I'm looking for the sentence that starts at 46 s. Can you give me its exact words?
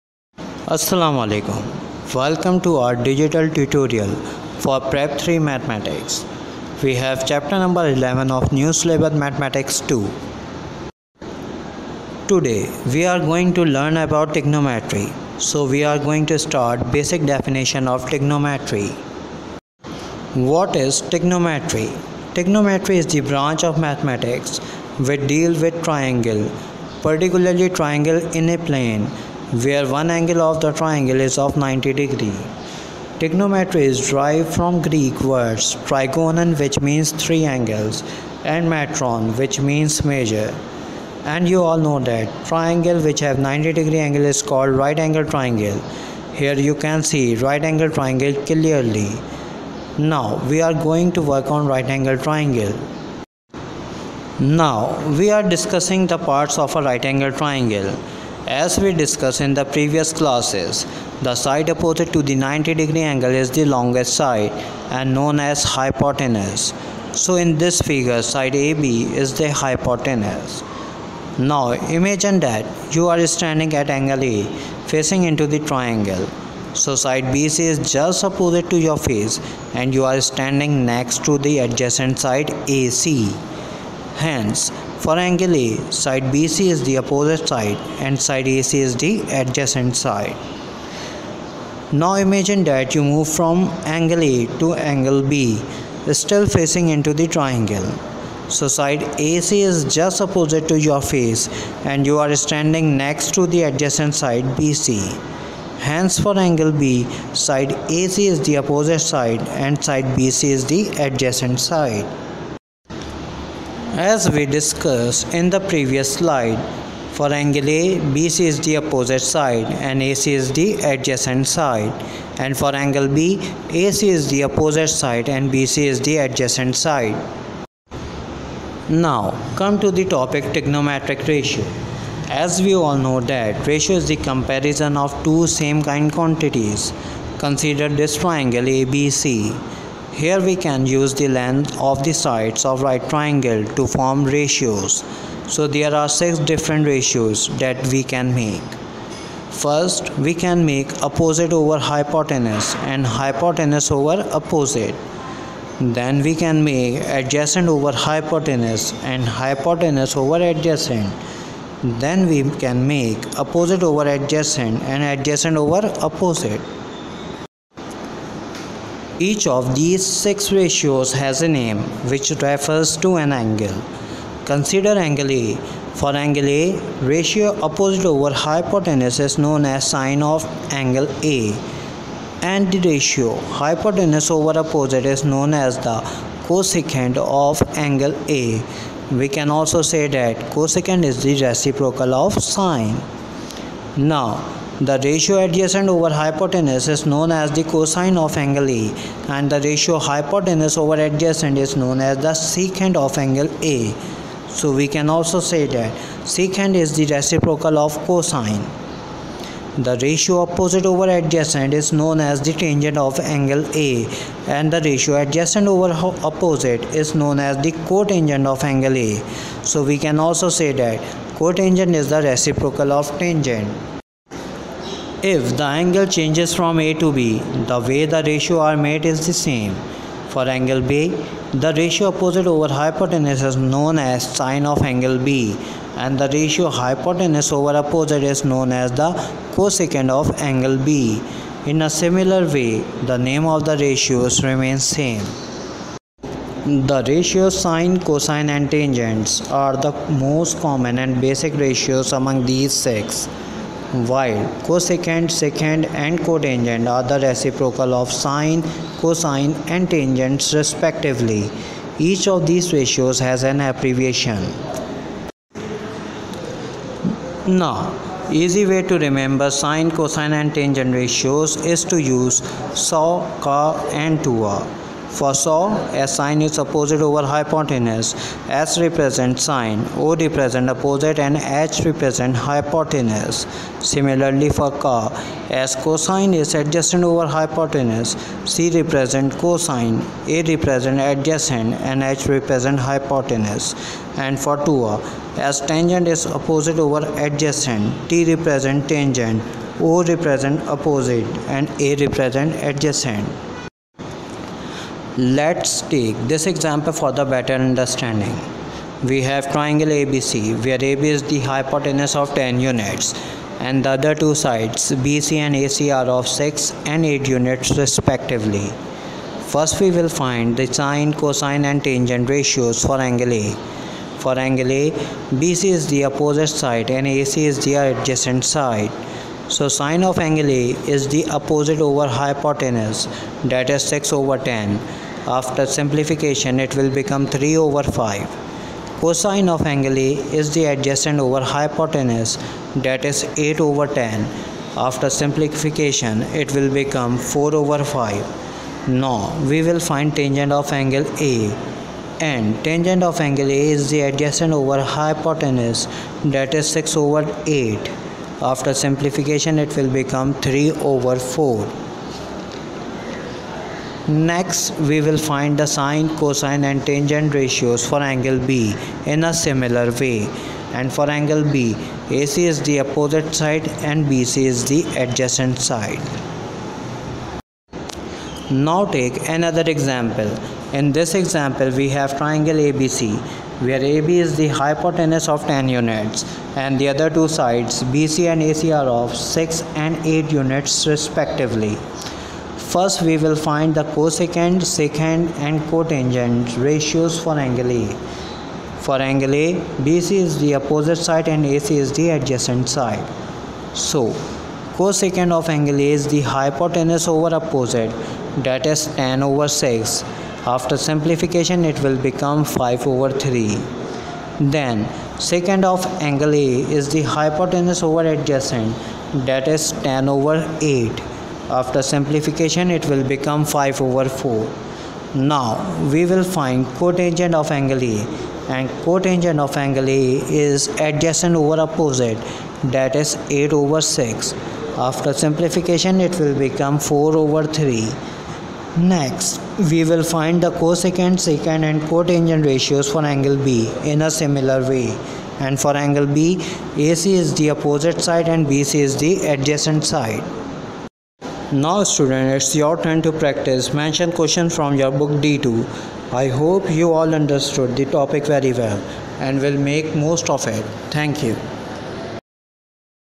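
Here you can see right angle triangle clearly.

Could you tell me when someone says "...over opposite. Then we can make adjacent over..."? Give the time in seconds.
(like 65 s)
153 s.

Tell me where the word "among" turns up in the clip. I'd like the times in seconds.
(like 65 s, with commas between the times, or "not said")
252 s.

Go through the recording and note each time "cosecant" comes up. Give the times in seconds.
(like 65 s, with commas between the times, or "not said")
186 s, 190 s, 239 s, 254 s, 393 s, 404 s, 440 s.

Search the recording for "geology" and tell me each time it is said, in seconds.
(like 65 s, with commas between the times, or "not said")
not said.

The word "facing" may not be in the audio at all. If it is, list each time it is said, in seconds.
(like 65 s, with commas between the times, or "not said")
74 s, 96 s.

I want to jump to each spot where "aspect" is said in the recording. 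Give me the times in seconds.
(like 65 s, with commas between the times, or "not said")
not said.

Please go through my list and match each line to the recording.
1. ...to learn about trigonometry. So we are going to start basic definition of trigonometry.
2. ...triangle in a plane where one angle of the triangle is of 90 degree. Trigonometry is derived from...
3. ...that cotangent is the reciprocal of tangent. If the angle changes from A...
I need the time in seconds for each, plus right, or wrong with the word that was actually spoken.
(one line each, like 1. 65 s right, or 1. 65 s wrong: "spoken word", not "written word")
1. 13 s right
2. 27 s right
3. 220 s right.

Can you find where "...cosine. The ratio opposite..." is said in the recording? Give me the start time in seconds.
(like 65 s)
208 s.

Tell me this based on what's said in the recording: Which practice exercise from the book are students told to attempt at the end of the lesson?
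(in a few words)
D2.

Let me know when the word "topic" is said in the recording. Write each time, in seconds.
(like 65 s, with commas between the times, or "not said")
130 s, 457 s.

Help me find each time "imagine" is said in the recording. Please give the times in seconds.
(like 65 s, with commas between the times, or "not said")
71 s, 92 s.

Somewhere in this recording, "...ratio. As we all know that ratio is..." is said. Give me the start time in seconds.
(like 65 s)
131 s.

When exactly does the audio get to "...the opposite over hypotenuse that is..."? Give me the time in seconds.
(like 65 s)
331 s.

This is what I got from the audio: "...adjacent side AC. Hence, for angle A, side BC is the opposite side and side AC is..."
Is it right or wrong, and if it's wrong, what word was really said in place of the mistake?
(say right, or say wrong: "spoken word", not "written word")
right.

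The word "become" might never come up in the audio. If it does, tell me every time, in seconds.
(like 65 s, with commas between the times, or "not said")
336 s, 346 s, 360 s, 412 s, 423 s, 436 s.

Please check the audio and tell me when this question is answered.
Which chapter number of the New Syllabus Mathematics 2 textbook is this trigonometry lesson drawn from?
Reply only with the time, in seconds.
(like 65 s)
7 s.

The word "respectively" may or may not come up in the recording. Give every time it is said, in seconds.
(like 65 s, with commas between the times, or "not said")
260 s, 317 s, 390 s.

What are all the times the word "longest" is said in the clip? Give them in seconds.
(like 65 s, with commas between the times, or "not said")
63 s.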